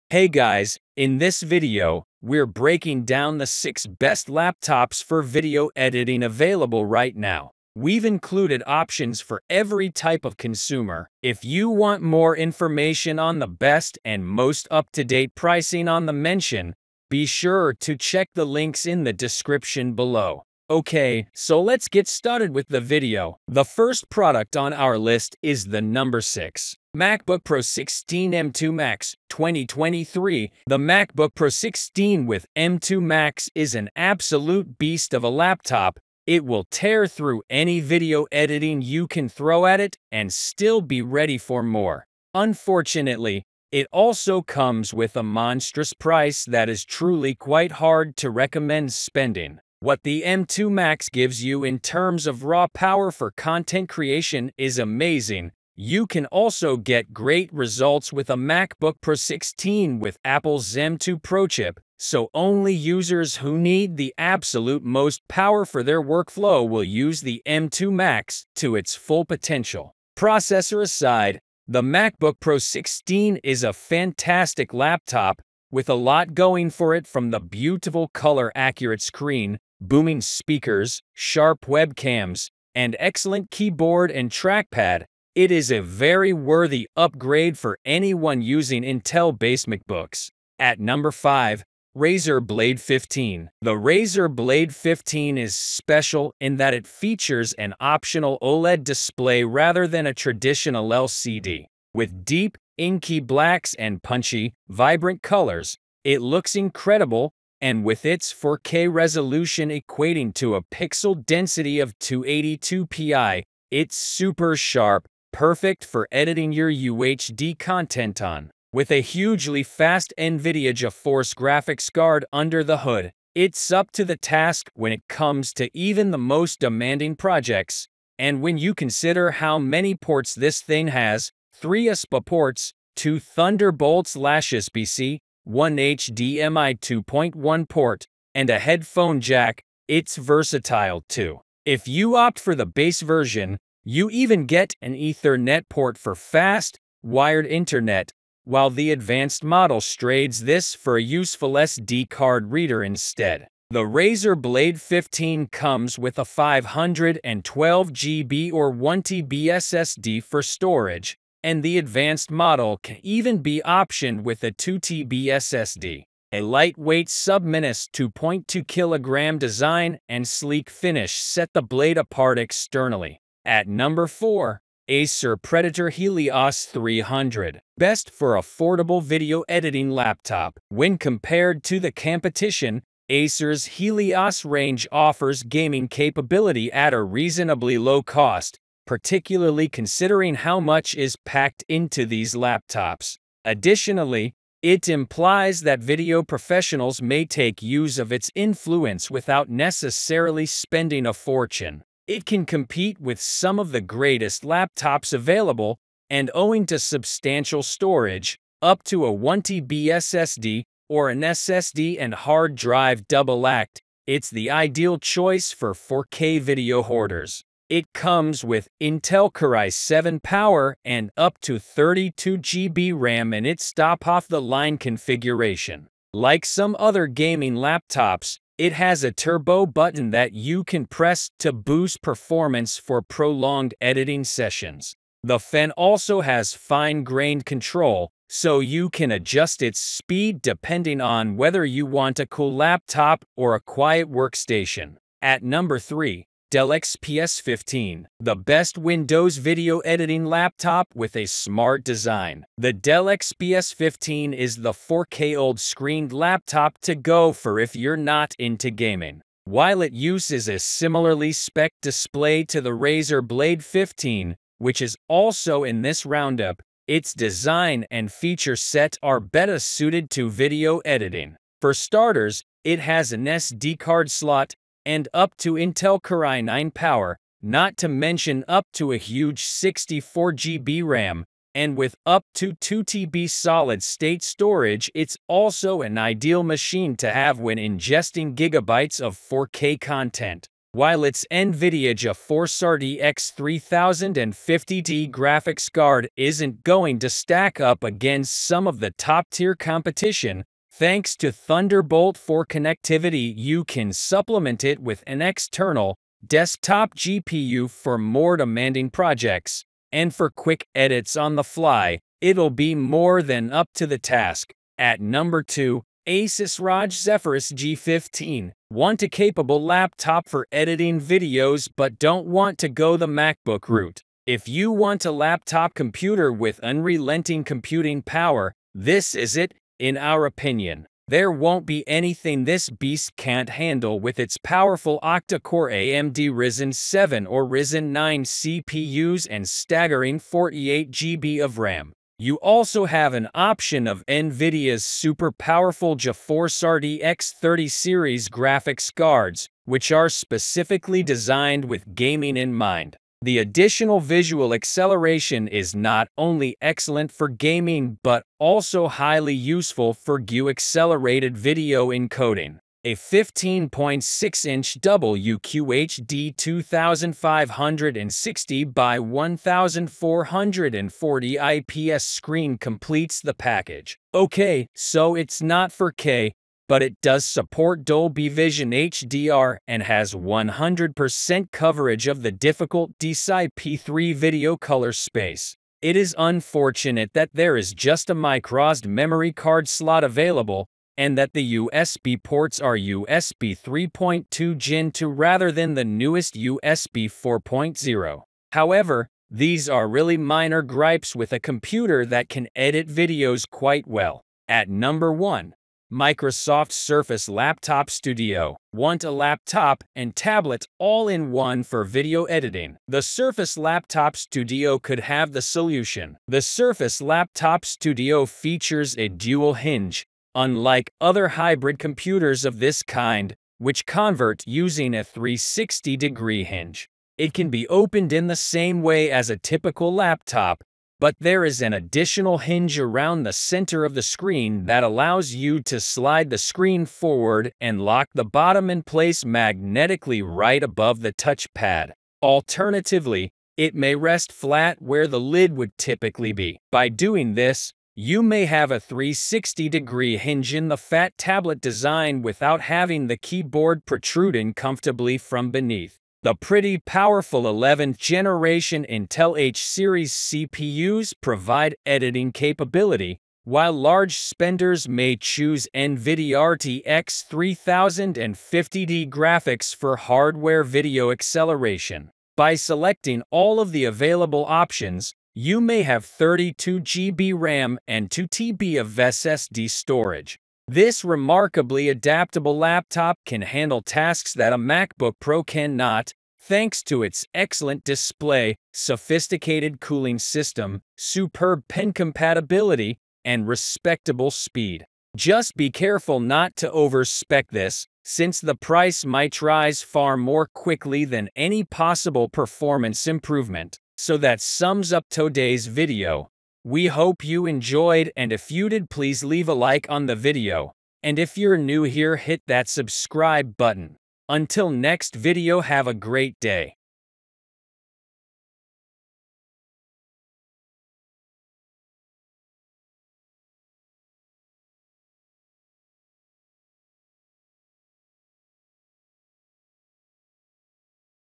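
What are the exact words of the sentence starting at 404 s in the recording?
At number 1, Microsoft Surface Laptop Studio.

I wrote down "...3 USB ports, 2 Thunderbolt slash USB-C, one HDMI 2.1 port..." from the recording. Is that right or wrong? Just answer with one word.
right.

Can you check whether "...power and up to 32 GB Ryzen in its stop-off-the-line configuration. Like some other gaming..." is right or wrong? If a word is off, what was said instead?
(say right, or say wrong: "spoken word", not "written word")
wrong: "RAM", not "Ryzen".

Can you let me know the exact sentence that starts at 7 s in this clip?
We've included options for every type of consumer.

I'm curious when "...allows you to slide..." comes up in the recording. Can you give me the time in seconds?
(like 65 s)
434 s.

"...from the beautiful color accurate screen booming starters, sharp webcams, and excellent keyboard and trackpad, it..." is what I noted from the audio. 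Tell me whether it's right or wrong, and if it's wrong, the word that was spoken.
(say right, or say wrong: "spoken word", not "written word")
wrong: "speakers", not "starters".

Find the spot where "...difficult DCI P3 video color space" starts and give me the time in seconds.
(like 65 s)
382 s.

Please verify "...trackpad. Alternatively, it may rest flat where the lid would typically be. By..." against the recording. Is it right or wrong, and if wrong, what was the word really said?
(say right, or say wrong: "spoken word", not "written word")
wrong: "touchpad", not "trackpad".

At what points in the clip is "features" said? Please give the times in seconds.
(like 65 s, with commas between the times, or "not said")
96 s, 268 s, 418 s.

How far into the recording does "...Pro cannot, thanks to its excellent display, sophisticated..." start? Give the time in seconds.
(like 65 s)
485 s.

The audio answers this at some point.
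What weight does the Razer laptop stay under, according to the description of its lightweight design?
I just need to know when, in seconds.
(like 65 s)
167 s.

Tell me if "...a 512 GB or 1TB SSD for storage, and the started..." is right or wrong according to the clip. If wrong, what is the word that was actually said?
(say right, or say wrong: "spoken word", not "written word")
wrong: "advanced", not "started".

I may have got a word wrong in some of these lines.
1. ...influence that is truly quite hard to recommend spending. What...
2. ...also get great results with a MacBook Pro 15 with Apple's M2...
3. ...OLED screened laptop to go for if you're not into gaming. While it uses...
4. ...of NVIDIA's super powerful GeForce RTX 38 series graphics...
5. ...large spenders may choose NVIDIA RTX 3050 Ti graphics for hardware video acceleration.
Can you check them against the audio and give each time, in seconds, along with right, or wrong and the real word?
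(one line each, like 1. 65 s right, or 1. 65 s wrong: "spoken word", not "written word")
1. 45 s wrong: "price", not "influence"
2. 56 s wrong: "16", not "15"
3. 255 s right
4. 343 s wrong: "30", not "38"
5. 463 s right.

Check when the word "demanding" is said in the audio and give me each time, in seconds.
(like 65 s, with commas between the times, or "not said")
126 s, 308 s.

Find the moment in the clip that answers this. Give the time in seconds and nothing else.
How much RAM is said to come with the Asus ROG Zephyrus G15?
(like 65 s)
340 s.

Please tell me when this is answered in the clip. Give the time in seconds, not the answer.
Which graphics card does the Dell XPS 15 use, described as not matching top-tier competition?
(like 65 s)
291 s.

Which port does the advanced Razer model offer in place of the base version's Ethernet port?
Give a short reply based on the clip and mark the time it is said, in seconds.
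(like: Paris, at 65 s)
SD card reader, at 151 s.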